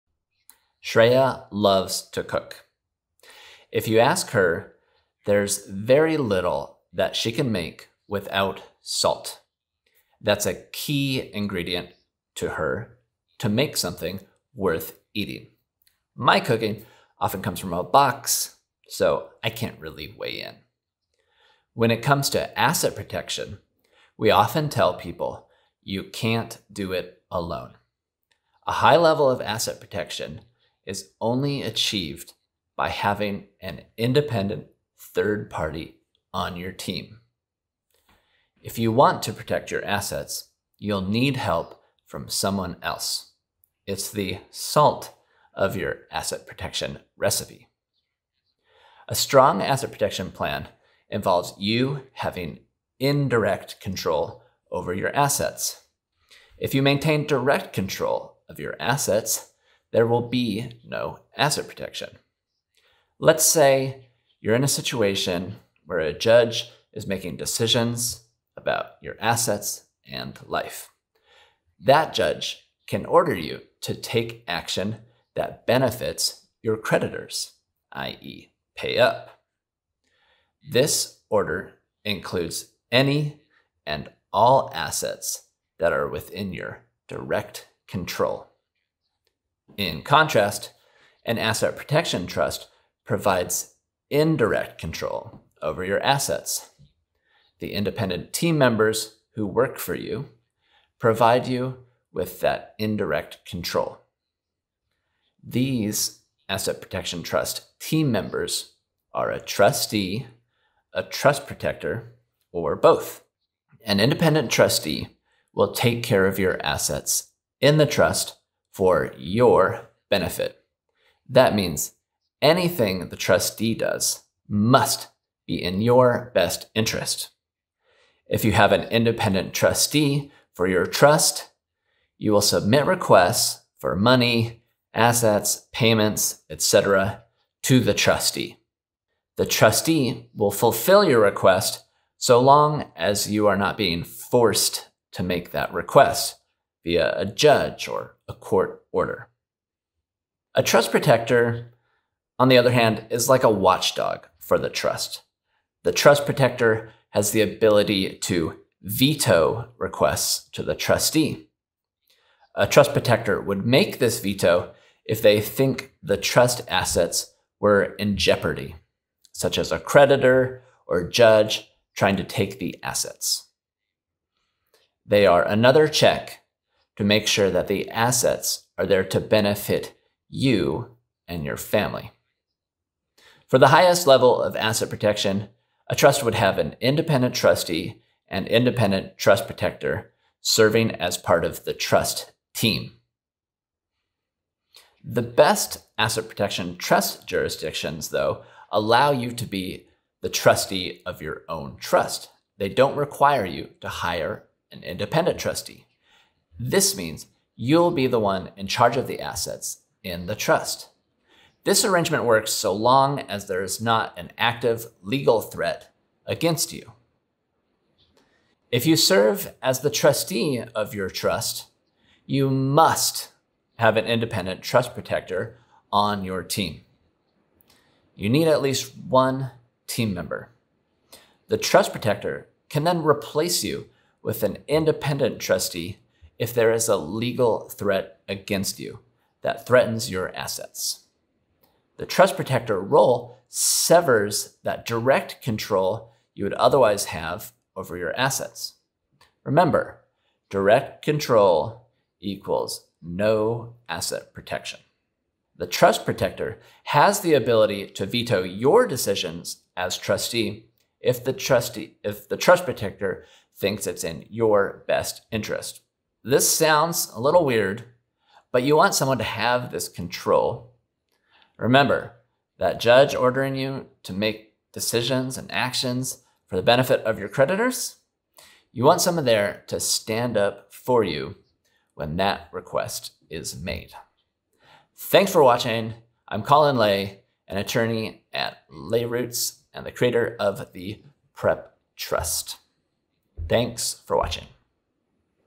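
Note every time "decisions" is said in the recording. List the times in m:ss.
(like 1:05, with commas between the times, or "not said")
1:07, 4:18, 4:34.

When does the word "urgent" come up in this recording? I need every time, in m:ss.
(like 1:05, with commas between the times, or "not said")
not said.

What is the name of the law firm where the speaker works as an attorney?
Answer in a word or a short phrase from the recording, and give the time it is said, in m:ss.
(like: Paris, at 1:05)
LayRoots, at 4:48.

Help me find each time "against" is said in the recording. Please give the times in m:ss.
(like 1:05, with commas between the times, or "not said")
3:36, 3:58.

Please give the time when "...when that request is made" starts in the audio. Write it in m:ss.
4:41.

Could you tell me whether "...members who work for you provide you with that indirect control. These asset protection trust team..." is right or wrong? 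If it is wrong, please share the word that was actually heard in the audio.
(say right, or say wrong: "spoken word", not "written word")
right.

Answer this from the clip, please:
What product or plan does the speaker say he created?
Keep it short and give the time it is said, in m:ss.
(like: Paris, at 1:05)
Prep Trust, at 4:51.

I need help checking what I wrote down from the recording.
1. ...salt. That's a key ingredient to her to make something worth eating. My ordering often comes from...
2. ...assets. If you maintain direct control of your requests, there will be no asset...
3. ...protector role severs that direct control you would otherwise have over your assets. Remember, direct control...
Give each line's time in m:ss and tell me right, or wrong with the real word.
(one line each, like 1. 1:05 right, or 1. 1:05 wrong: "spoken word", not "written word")
1. 0:08 wrong: "cooking", not "ordering"
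2. 0:55 wrong: "assets", not "requests"
3. 4:02 right.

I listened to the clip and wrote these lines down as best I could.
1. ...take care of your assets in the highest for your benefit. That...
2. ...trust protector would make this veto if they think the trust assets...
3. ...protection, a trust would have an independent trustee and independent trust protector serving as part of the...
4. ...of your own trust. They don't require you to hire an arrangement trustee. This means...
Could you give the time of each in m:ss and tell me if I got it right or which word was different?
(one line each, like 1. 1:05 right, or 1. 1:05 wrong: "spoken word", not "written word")
1. 1:55 wrong: "trust", not "highest"
2. 2:42 right
3. 3:04 right
4. 3:21 wrong: "independent", not "arrangement".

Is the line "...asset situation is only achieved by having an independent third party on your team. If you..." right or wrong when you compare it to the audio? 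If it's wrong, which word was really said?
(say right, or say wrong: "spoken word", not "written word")
wrong: "protection", not "situation".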